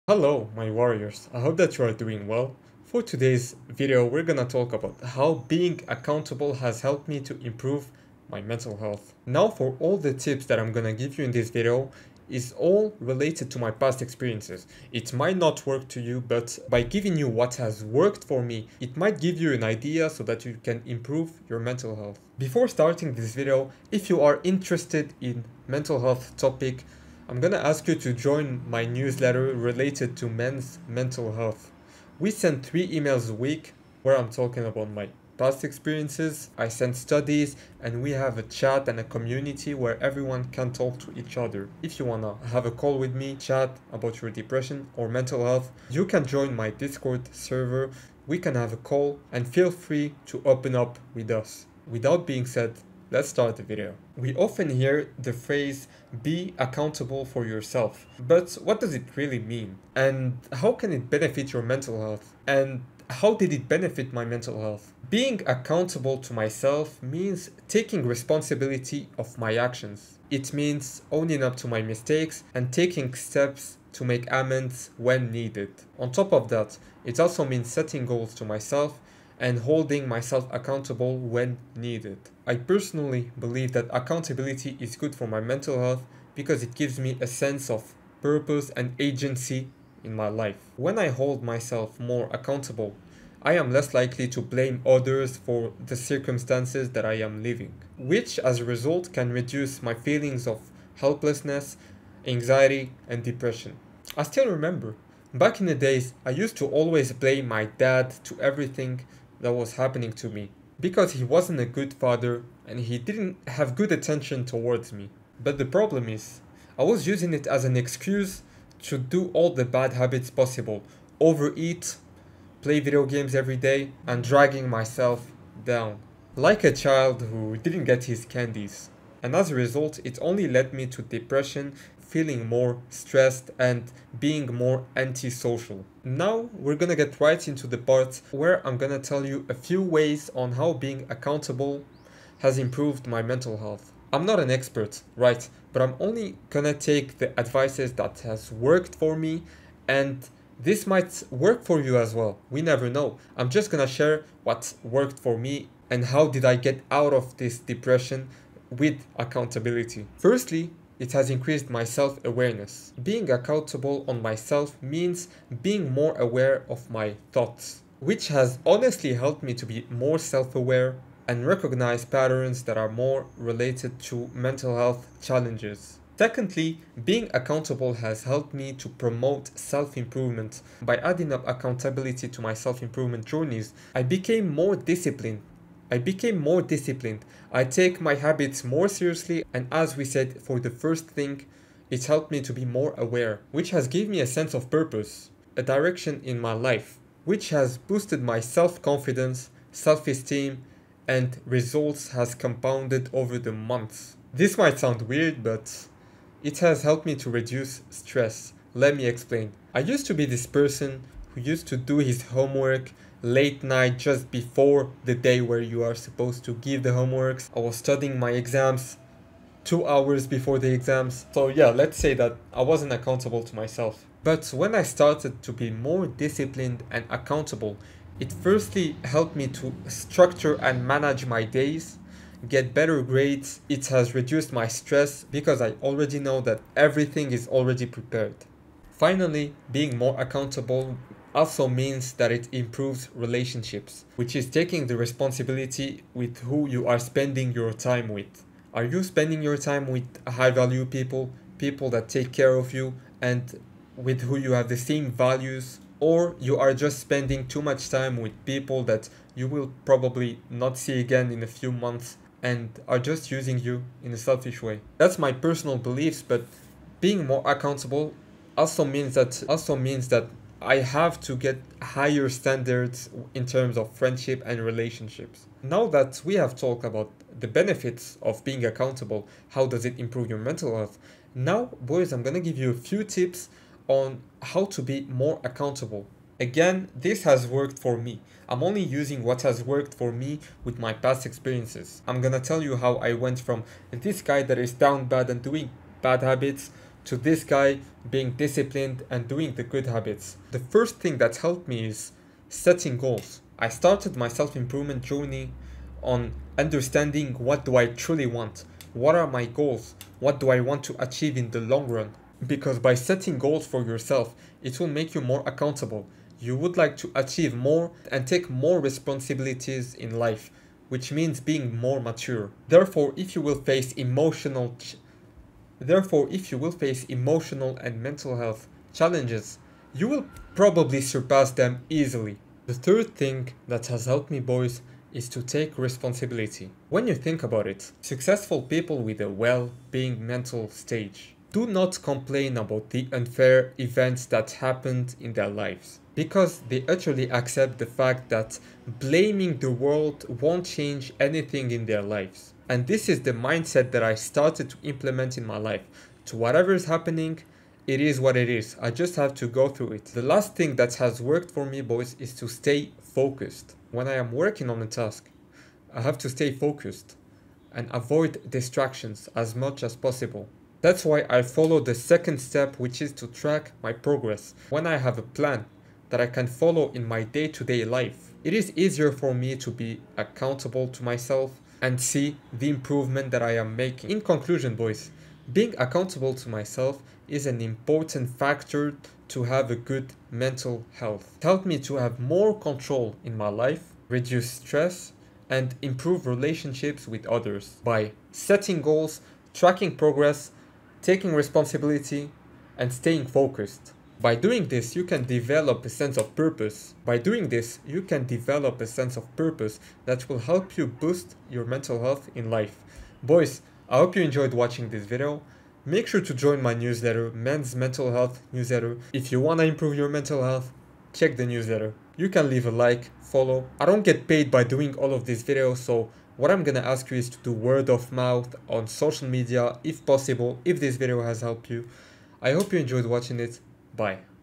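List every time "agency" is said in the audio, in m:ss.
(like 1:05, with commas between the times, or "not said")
1:28.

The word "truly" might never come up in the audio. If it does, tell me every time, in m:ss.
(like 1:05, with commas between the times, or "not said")
5:07.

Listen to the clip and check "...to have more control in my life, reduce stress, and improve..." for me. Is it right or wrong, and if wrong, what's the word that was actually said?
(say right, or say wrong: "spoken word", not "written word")
right.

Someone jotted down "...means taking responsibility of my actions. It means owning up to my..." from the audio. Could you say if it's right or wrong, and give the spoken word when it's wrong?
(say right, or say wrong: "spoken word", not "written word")
right.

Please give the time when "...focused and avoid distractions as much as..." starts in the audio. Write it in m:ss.
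6:06.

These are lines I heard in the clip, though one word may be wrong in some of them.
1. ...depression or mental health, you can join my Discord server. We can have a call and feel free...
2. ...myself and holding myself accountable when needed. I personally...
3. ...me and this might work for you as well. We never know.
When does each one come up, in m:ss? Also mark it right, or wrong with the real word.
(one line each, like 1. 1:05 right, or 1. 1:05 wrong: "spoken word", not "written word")
1. 0:44 right
2. 1:18 right
3. 2:29 right.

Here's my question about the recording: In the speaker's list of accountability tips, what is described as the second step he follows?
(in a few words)
Track my progress.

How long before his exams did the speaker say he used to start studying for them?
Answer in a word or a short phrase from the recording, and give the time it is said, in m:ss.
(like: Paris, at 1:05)
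2 hours, at 3:39.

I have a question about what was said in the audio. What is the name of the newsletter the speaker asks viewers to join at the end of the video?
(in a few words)
Men's Mental Health Newsletter.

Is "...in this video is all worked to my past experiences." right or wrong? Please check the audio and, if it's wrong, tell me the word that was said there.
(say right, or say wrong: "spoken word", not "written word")
wrong: "related", not "worked".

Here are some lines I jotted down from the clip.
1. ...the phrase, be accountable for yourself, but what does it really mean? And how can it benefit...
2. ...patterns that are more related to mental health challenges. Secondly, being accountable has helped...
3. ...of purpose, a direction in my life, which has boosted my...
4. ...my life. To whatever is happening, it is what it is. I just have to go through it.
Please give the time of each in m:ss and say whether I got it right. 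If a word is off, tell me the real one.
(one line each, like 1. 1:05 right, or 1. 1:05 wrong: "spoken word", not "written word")
1. 0:55 right
2. 2:52 right
3. 3:14 right
4. 5:55 right.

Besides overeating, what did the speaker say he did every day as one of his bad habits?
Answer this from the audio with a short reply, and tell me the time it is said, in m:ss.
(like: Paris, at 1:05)
Play video games, at 2:02.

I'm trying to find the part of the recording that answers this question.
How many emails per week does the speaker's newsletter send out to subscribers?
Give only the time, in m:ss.
0:32.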